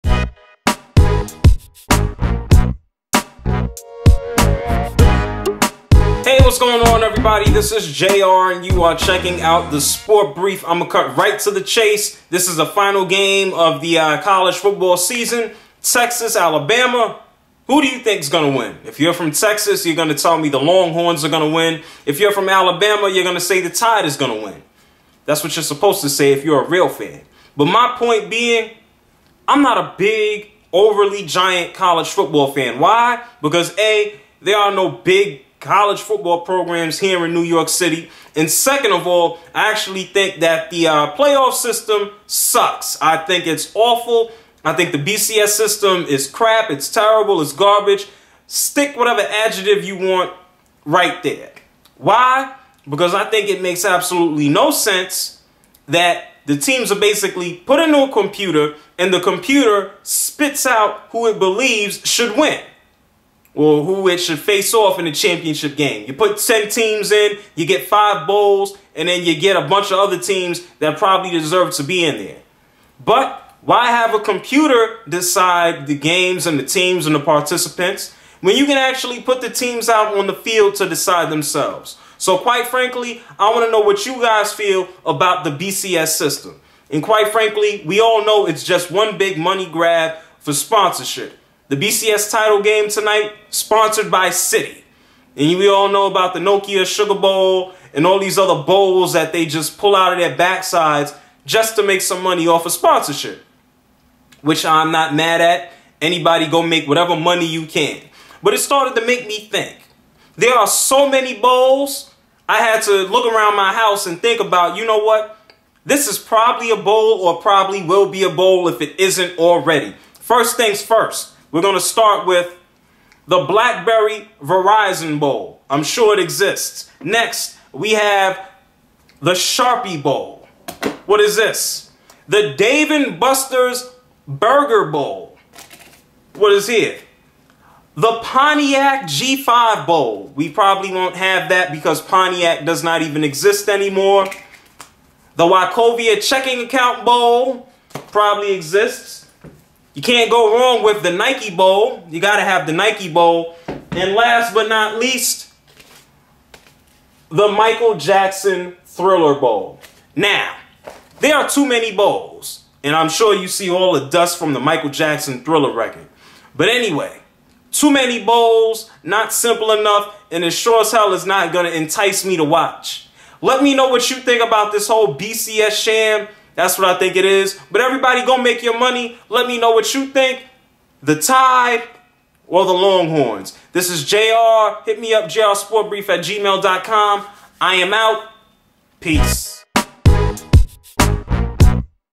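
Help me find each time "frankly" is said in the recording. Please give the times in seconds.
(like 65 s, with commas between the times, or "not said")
82 s, 87 s.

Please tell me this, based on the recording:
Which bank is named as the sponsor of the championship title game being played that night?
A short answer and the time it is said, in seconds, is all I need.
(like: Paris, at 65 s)
Citi, at 94 s.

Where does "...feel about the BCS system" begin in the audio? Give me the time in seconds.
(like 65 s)
84 s.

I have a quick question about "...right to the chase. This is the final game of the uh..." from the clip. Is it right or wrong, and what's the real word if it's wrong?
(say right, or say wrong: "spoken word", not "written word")
right.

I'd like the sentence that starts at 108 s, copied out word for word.
But it started to make me think.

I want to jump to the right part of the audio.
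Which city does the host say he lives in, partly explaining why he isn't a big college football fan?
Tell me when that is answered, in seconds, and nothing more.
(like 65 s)
37 s.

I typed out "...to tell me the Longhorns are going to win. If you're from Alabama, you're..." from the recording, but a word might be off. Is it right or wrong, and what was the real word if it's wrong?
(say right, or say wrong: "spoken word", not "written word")
right.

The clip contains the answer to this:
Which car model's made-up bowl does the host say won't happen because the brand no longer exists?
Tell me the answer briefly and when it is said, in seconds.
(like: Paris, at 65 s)
Pontiac G5, at 138 s.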